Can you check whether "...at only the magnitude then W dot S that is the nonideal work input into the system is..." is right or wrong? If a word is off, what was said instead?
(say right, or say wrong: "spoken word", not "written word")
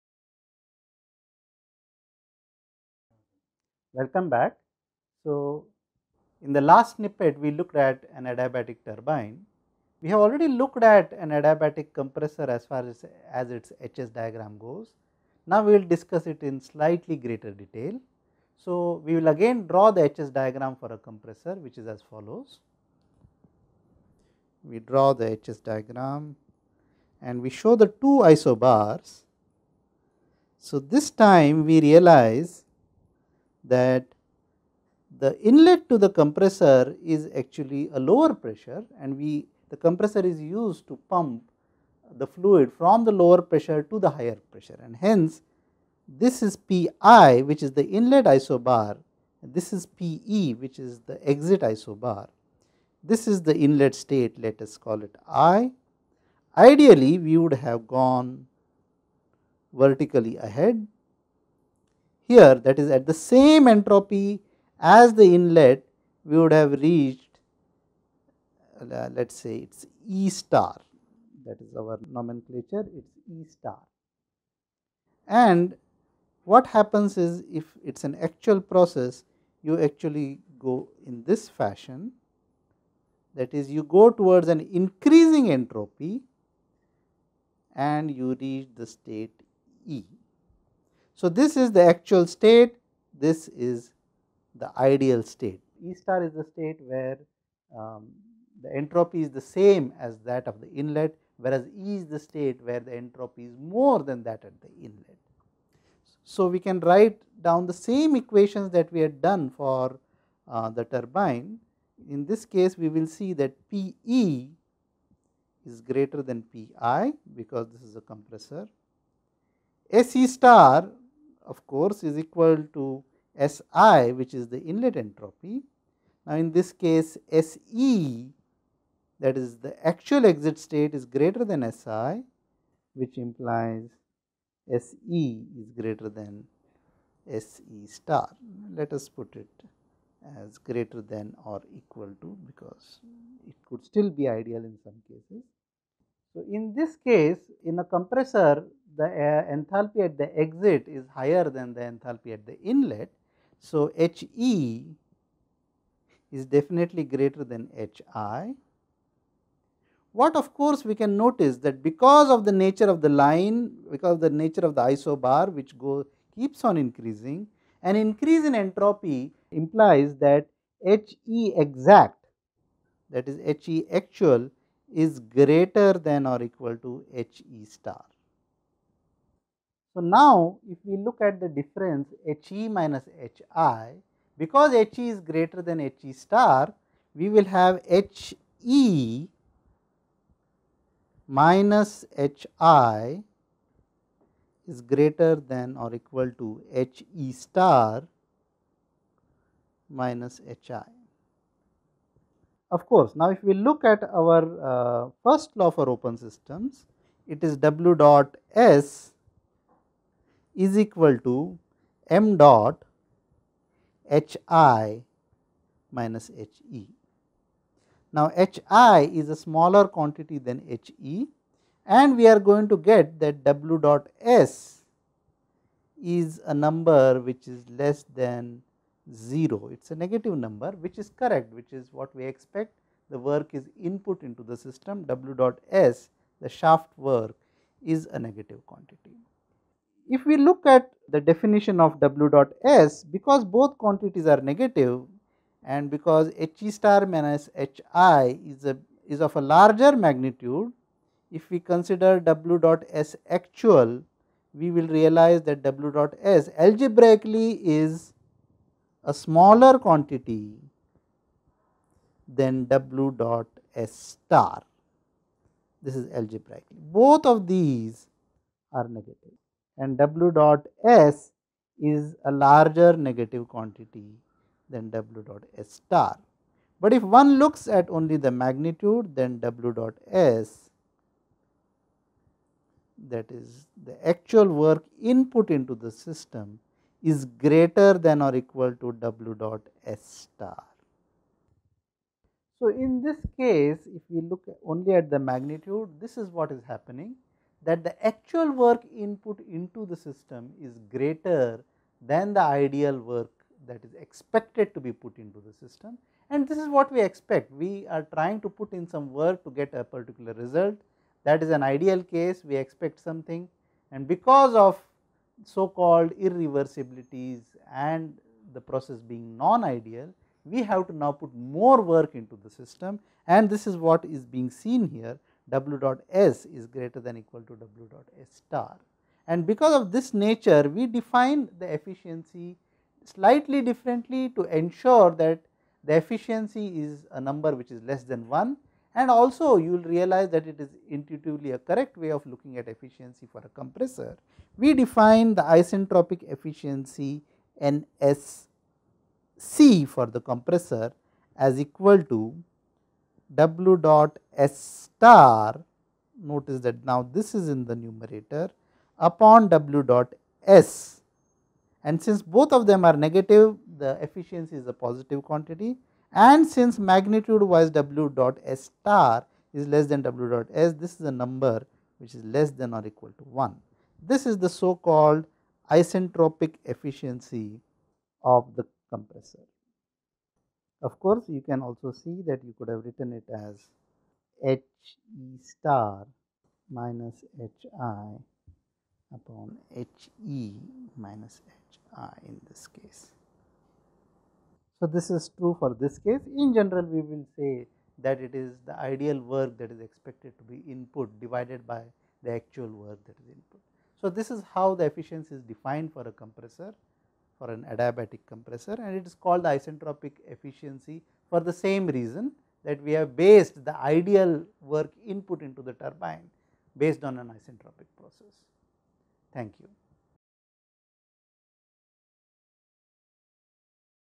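wrong: "actual", not "nonideal".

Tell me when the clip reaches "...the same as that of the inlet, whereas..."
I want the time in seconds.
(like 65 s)
99 s.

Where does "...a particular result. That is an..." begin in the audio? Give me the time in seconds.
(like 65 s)
309 s.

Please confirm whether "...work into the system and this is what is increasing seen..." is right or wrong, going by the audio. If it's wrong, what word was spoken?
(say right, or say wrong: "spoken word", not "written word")
wrong: "being", not "increasing".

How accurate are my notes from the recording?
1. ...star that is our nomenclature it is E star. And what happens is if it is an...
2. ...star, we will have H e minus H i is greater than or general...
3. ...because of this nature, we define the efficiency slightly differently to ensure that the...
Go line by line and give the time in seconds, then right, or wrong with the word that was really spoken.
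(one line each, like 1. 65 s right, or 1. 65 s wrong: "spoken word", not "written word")
1. 70 s right
2. 186 s wrong: "equal", not "general"
3. 329 s right.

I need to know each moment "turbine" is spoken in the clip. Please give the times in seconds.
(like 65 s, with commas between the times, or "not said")
8 s, 110 s, 415 s.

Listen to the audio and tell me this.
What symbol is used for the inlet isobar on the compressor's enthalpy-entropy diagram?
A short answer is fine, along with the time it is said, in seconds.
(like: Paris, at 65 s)
Pi, at 46 s.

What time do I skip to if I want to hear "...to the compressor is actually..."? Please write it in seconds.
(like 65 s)
35 s.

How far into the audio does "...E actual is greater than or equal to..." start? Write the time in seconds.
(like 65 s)
173 s.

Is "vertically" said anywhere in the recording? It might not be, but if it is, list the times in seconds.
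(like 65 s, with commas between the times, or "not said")
59 s.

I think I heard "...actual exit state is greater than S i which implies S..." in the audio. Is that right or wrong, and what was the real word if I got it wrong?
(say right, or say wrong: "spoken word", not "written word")
right.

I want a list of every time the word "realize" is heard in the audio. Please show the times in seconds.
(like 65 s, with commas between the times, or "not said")
31 s, 254 s, 339 s.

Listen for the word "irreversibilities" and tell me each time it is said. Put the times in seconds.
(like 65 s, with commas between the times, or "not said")
316 s.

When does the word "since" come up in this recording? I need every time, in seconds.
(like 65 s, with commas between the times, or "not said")
362 s, 366 s.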